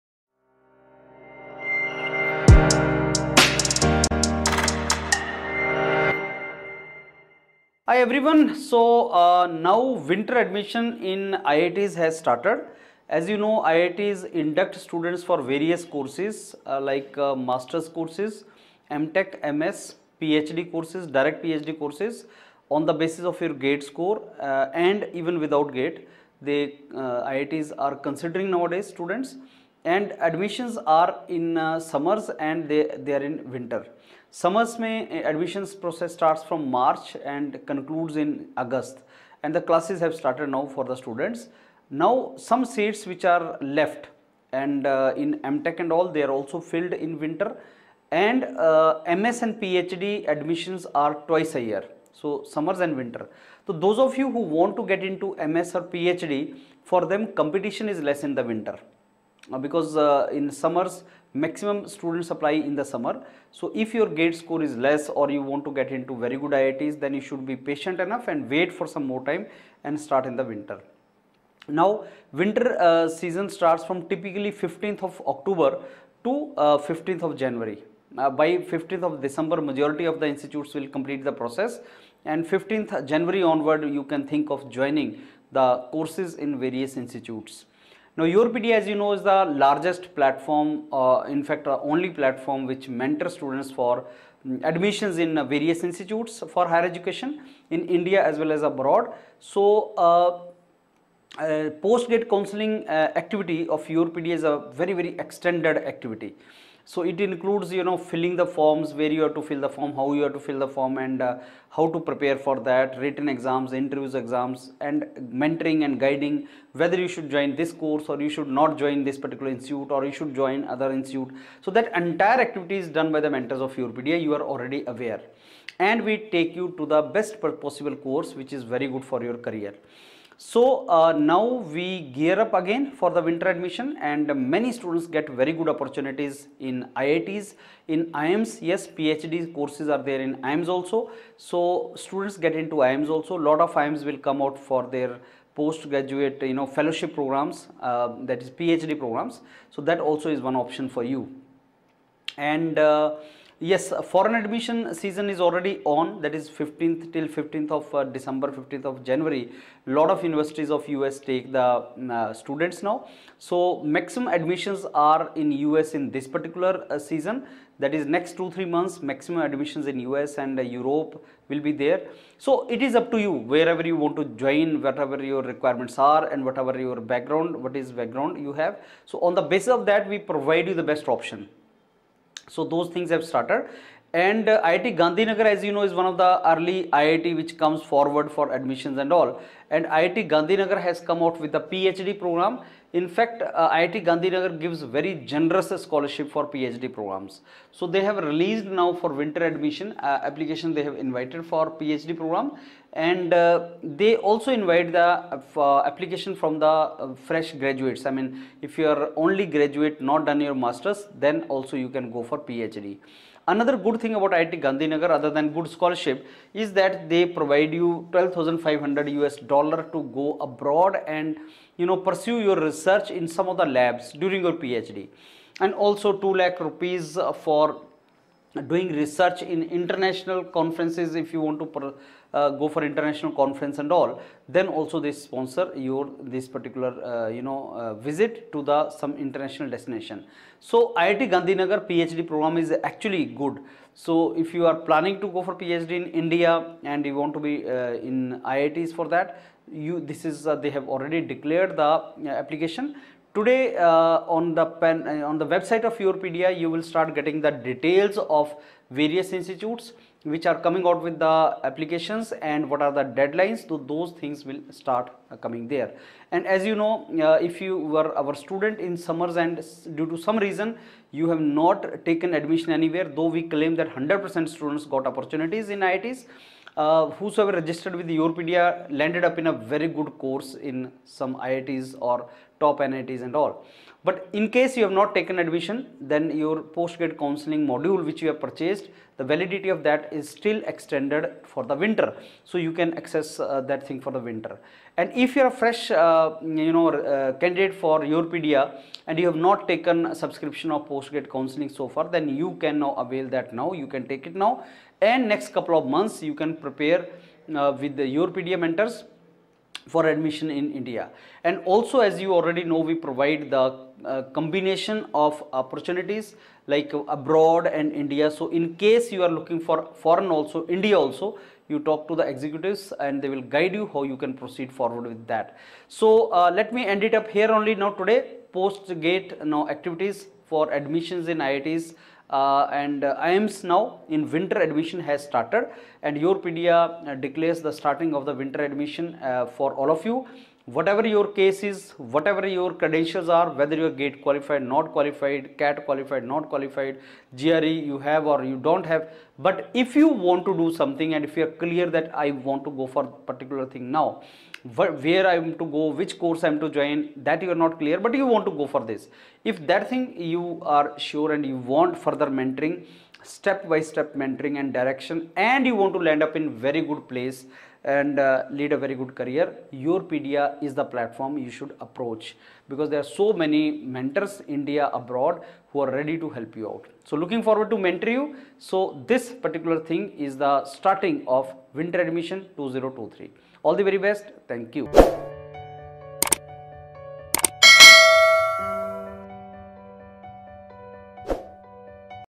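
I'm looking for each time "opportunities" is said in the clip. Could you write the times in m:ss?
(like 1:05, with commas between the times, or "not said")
2:15, 4:35, 5:15.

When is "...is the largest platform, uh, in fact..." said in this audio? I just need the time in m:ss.
1:29.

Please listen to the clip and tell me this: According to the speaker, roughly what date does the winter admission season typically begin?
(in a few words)
15th of October.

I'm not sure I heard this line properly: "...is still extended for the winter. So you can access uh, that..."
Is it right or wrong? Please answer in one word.
right.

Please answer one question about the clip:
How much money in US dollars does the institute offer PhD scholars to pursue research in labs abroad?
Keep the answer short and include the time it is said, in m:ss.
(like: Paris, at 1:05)
12,500 US dollars, at 3:38.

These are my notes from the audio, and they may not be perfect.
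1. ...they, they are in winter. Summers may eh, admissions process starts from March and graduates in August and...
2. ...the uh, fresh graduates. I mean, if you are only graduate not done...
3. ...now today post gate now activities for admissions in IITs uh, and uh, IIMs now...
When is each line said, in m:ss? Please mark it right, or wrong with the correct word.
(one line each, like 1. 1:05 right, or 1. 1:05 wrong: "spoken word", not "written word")
1. 0:32 wrong: "concludes", not "graduates"
2. 3:26 right
3. 5:27 right.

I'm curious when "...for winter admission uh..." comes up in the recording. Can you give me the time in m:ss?
3:18.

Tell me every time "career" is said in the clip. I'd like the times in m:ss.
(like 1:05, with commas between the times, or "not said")
2:09, 6:09.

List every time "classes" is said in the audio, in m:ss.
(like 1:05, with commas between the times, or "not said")
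0:39.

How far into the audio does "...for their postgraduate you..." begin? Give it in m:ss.
2:24.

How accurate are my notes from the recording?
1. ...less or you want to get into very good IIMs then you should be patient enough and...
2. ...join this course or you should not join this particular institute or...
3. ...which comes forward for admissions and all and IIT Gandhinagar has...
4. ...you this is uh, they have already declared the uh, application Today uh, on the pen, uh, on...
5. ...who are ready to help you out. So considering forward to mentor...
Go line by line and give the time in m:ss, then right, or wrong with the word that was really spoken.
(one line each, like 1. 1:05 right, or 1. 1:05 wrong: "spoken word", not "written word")
1. 1:04 wrong: "IITs", not "IIMs"
2. 1:57 right
3. 3:07 right
4. 4:09 right
5. 6:15 wrong: "looking", not "considering".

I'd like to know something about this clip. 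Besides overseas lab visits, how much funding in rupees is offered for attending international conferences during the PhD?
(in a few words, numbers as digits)
2 lakh rupees.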